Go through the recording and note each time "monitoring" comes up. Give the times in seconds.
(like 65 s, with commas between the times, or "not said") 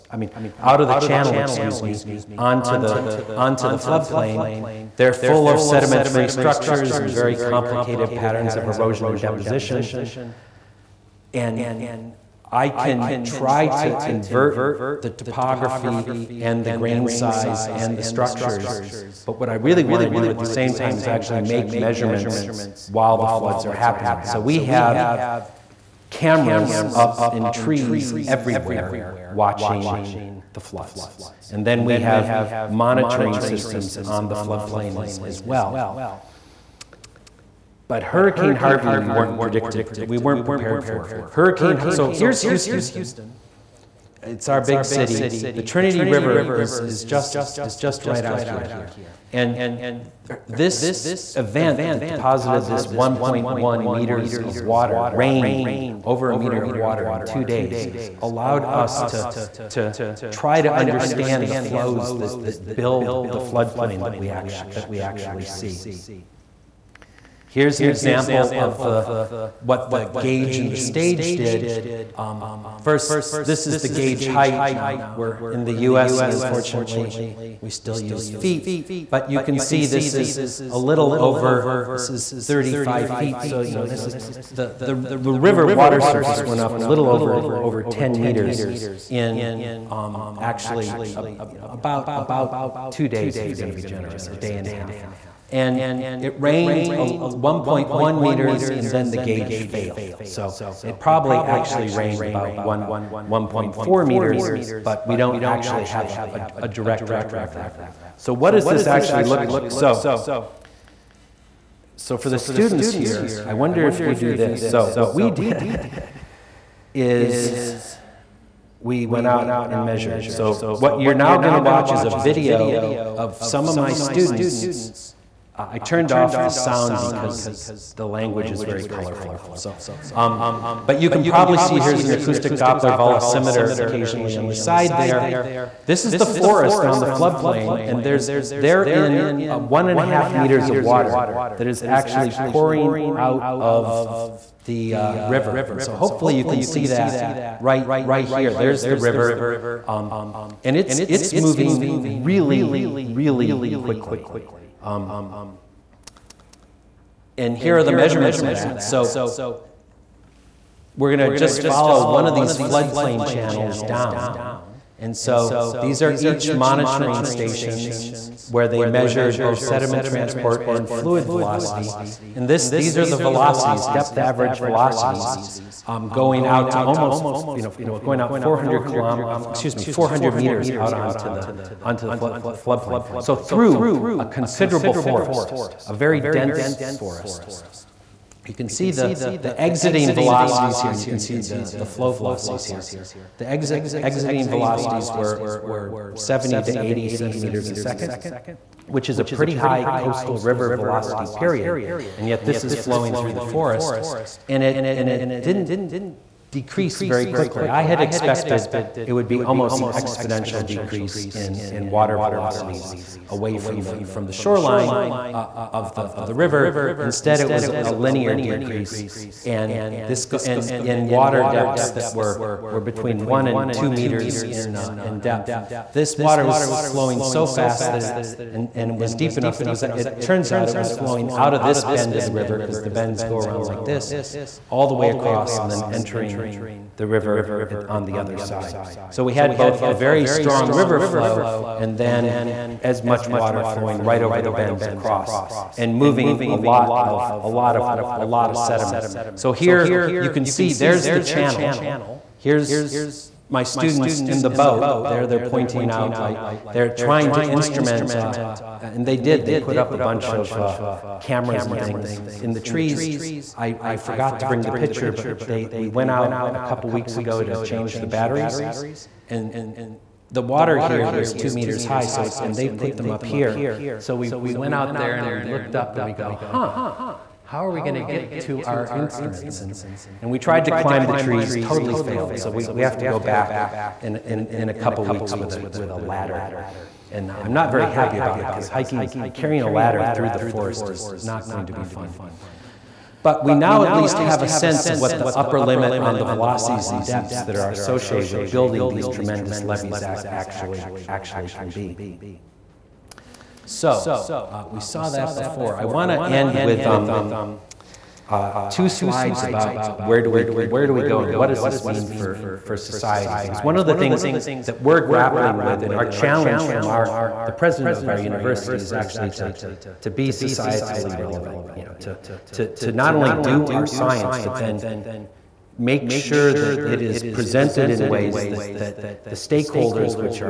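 32 s, 166 s.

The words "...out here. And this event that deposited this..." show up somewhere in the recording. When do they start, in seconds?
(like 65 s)
48 s.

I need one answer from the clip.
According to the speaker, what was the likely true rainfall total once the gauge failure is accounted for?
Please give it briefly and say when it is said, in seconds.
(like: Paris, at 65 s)
1.4 meters, at 102 s.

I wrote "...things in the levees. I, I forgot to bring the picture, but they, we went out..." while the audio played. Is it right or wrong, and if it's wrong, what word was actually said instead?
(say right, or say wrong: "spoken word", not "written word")
wrong: "trees", not "levees".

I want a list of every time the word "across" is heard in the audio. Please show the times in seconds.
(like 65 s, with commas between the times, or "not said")
235 s, 244 s.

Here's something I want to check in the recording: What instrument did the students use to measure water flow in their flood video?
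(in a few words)
acoustic Doppler velocimeter.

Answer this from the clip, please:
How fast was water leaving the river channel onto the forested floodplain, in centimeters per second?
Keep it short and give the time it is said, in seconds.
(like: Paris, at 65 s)
70 to 80, at 196 s.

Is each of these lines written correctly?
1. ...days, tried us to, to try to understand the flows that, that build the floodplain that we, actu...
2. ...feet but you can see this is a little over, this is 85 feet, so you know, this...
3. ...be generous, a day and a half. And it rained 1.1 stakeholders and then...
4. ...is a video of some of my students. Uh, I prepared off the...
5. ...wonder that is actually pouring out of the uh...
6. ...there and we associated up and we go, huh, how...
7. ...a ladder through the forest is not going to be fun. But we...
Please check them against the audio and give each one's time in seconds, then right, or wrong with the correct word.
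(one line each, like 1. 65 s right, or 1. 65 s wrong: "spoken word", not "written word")
1. 57 s wrong: "allowed", not "tried"
2. 78 s wrong: "35", not "85"
3. 93 s wrong: "meters", not "stakeholders"
4. 121 s wrong: "turned", not "prepared"
5. 140 s wrong: "water", not "wonder"
6. 274 s wrong: "looked", not "associated"
7. 289 s right.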